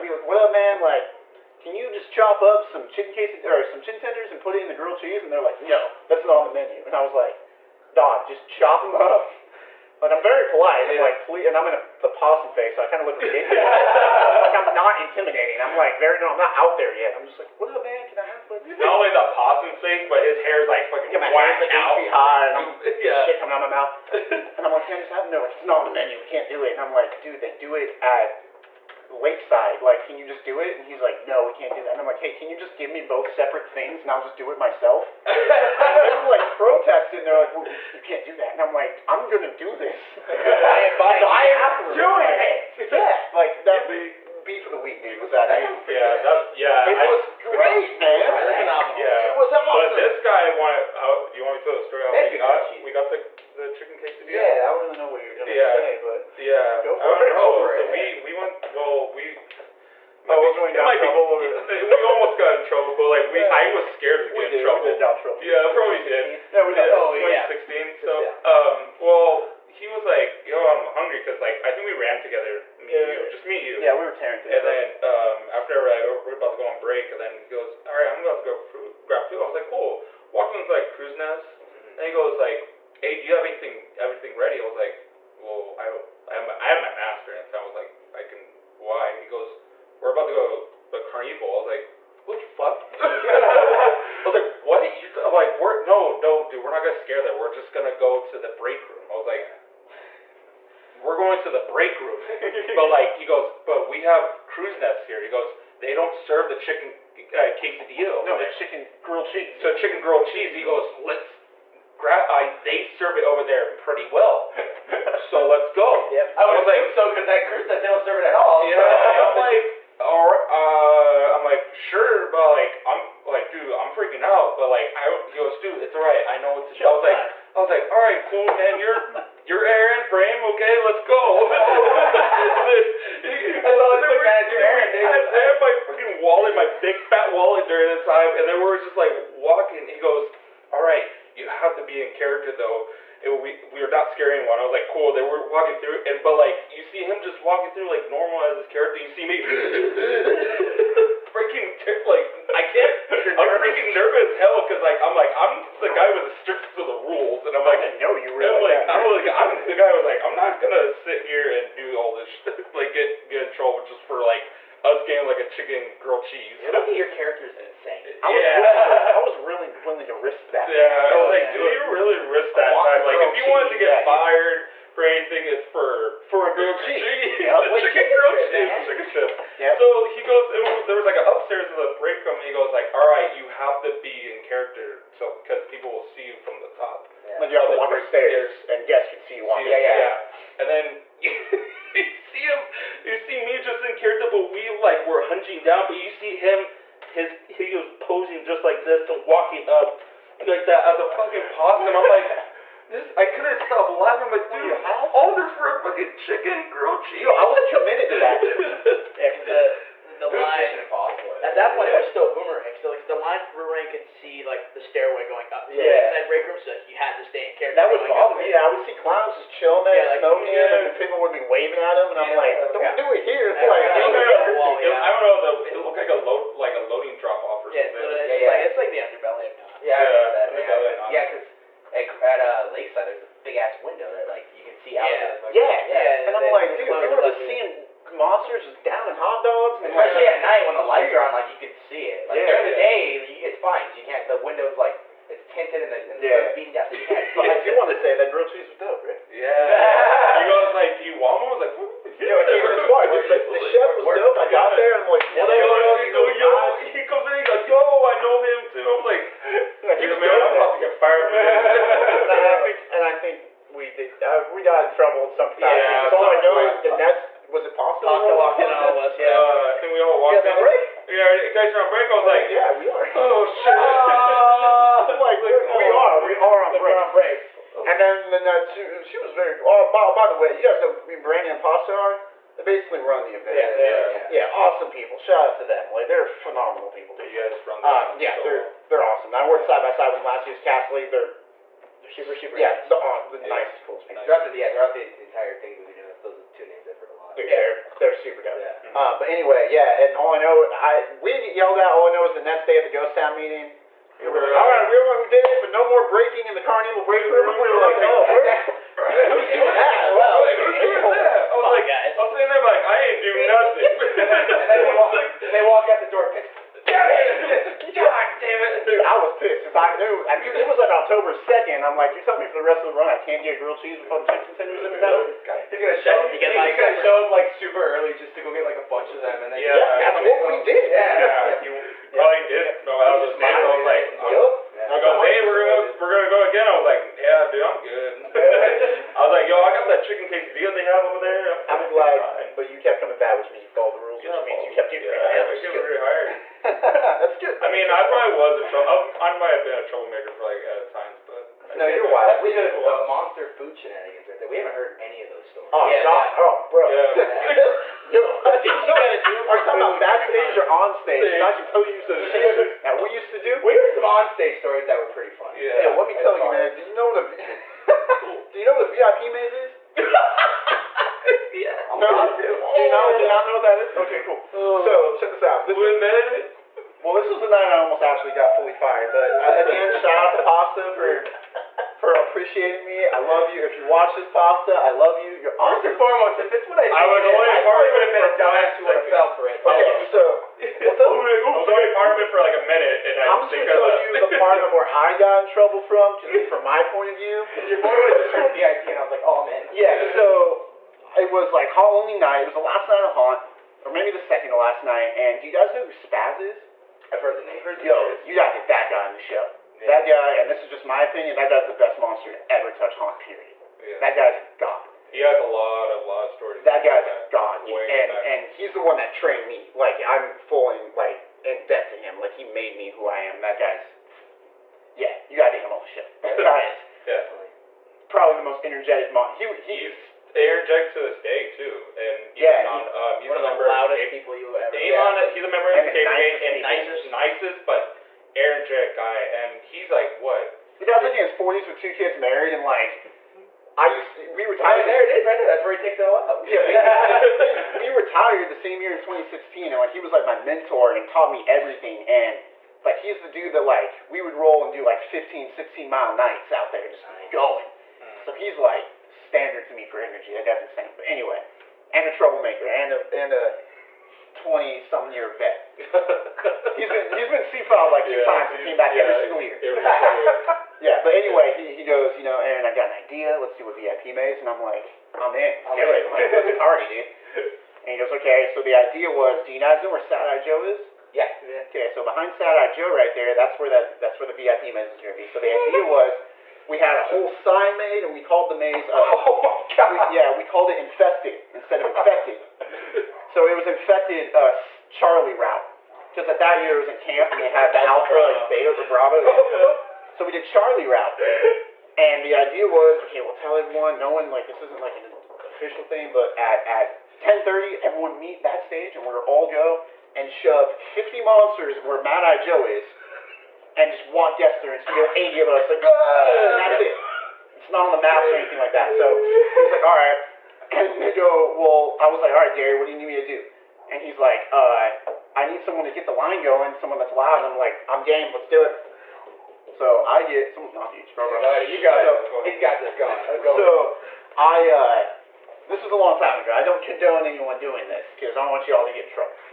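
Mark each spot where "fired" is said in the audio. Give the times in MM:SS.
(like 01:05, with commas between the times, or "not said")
02:54, 04:20, 06:18.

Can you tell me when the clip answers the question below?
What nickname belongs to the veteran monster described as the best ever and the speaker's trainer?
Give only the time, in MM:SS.
06:45.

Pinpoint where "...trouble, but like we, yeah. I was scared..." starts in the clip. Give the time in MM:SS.
01:02.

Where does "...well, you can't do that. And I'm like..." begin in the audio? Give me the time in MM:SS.
00:37.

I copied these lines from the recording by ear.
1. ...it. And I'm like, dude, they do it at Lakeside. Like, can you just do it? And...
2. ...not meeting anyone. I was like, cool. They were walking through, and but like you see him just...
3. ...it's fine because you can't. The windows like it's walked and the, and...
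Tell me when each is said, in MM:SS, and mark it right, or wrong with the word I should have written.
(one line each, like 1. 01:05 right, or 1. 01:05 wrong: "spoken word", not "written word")
1. 00:26 right
2. 02:23 wrong: "scaring", not "meeting"
3. 04:03 wrong: "tinted", not "walked".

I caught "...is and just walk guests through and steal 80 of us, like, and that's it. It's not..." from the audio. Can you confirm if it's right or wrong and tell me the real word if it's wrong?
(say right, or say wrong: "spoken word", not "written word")
right.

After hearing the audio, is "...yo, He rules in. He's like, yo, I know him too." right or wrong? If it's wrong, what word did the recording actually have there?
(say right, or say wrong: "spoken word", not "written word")
wrong: "comes", not "rules".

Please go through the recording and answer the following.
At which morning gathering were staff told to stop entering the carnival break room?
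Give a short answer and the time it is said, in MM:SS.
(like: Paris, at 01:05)
Ghost Town meeting, at 05:02.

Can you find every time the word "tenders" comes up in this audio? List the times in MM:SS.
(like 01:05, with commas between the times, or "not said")
00:03, 05:24.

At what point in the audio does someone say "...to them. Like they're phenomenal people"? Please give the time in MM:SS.
04:45.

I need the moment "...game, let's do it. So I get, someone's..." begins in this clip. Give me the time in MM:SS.
08:48.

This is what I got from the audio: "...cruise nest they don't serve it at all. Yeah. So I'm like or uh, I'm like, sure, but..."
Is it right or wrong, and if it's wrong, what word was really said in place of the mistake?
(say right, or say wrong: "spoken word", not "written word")
right.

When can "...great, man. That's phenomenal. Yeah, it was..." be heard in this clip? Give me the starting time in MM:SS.
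00:47.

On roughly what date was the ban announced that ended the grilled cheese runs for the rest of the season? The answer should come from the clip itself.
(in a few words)
October 2nd.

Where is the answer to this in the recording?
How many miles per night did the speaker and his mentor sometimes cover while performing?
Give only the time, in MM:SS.
07:34.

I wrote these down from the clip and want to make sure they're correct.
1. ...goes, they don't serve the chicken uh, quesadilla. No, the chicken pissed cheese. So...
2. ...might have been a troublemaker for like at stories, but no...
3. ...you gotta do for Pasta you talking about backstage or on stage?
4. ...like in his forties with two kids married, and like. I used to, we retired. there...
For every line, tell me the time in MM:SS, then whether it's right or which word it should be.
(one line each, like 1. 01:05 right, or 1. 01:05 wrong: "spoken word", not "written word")
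1. 01:45 wrong: "grilled", not "pissed"
2. 05:49 wrong: "times", not "stories"
3. 05:58 wrong: "Are", not "Pasta"
4. 07:21 right.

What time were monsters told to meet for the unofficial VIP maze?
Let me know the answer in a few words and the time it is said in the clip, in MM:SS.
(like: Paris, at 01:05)
10:30, at 08:27.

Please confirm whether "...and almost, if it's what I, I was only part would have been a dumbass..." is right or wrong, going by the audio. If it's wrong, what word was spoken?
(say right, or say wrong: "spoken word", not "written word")
wrong: "foremost", not "almost".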